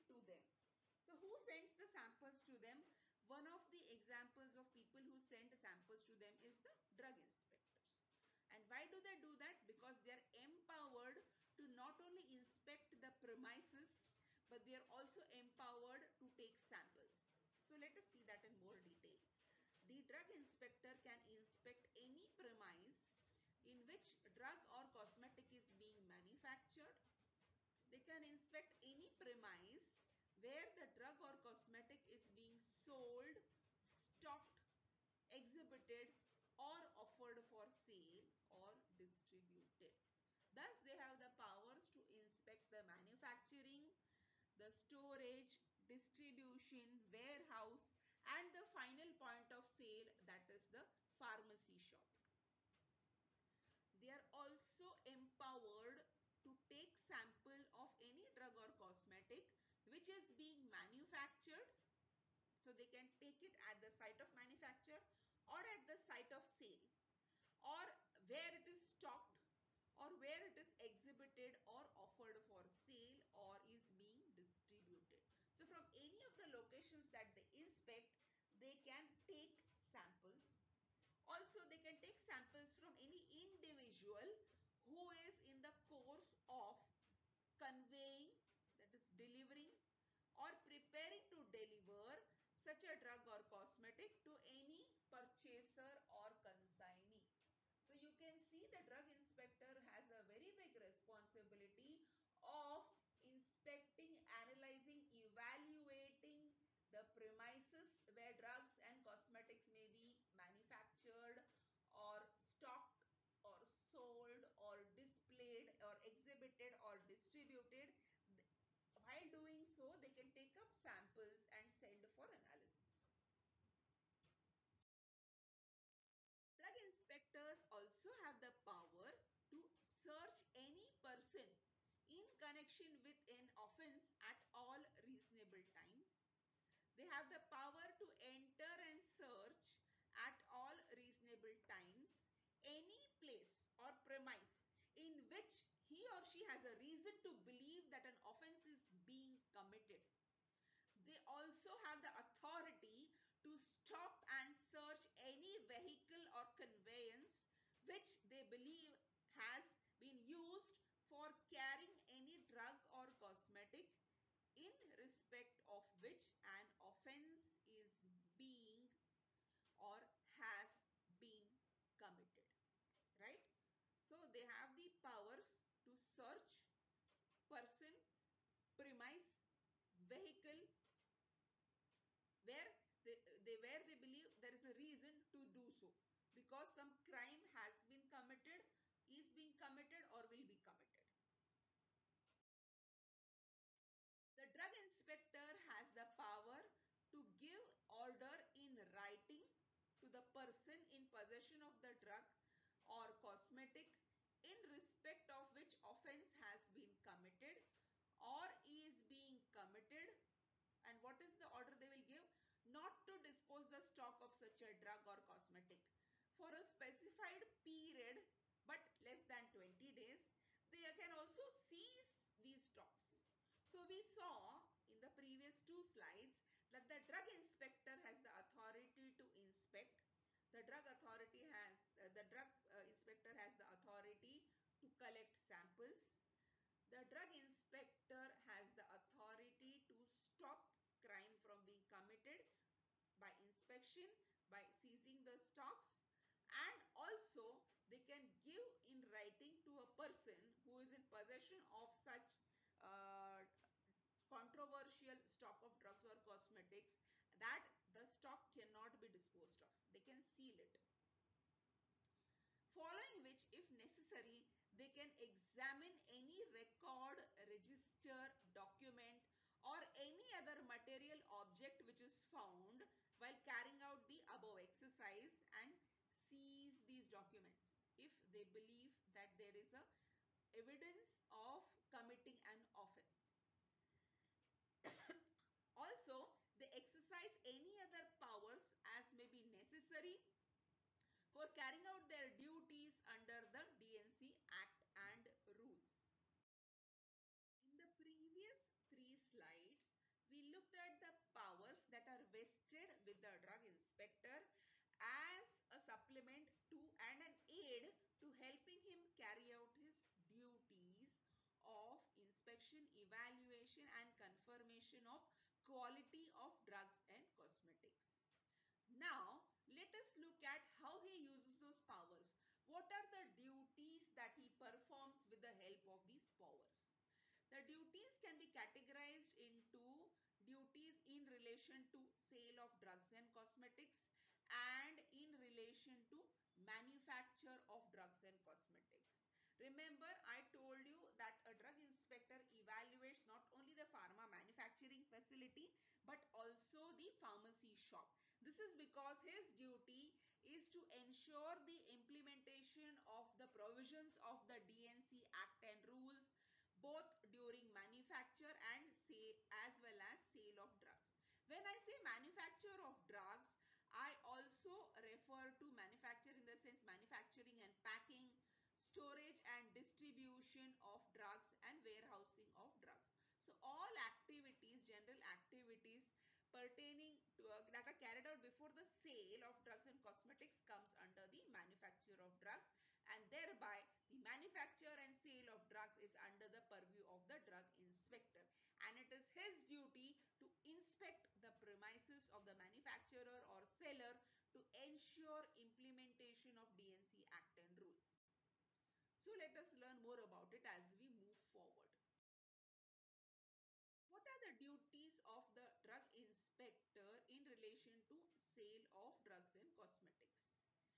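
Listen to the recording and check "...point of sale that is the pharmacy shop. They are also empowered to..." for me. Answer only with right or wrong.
right.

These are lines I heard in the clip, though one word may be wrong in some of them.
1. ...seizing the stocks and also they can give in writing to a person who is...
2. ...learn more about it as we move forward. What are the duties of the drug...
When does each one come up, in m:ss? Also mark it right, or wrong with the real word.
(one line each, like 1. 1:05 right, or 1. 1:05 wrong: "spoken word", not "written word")
1. 4:04 right
2. 6:39 right.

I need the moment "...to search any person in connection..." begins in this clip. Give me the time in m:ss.
2:09.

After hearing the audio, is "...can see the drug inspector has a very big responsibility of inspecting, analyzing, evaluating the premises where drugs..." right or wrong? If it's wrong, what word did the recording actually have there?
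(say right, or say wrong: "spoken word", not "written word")
right.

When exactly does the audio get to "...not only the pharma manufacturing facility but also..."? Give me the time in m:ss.
5:43.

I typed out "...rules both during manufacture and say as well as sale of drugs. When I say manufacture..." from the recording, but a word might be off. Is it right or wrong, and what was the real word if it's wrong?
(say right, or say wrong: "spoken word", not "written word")
right.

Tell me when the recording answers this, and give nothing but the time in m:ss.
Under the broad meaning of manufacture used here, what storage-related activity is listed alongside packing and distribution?
6:11.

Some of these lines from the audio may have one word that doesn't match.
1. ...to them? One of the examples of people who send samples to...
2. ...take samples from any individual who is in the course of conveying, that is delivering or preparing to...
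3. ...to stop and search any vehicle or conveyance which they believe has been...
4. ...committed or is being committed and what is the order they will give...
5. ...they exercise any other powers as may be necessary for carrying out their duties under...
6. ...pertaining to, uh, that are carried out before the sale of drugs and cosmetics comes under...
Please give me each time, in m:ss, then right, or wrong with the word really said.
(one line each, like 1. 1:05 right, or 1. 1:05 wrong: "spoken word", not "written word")
1. 0:02 right
2. 1:21 right
3. 2:33 right
4. 3:27 right
5. 4:46 right
6. 6:16 right.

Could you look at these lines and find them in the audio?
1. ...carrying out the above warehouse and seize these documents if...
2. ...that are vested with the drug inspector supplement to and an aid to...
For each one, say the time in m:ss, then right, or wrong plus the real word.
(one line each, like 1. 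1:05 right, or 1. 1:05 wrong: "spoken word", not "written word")
1. 4:33 wrong: "exercise", not "warehouse"
2. 5:01 right.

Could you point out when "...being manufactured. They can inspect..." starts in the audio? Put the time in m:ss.
0:25.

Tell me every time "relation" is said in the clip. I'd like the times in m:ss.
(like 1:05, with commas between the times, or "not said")
5:31, 5:35, 6:47.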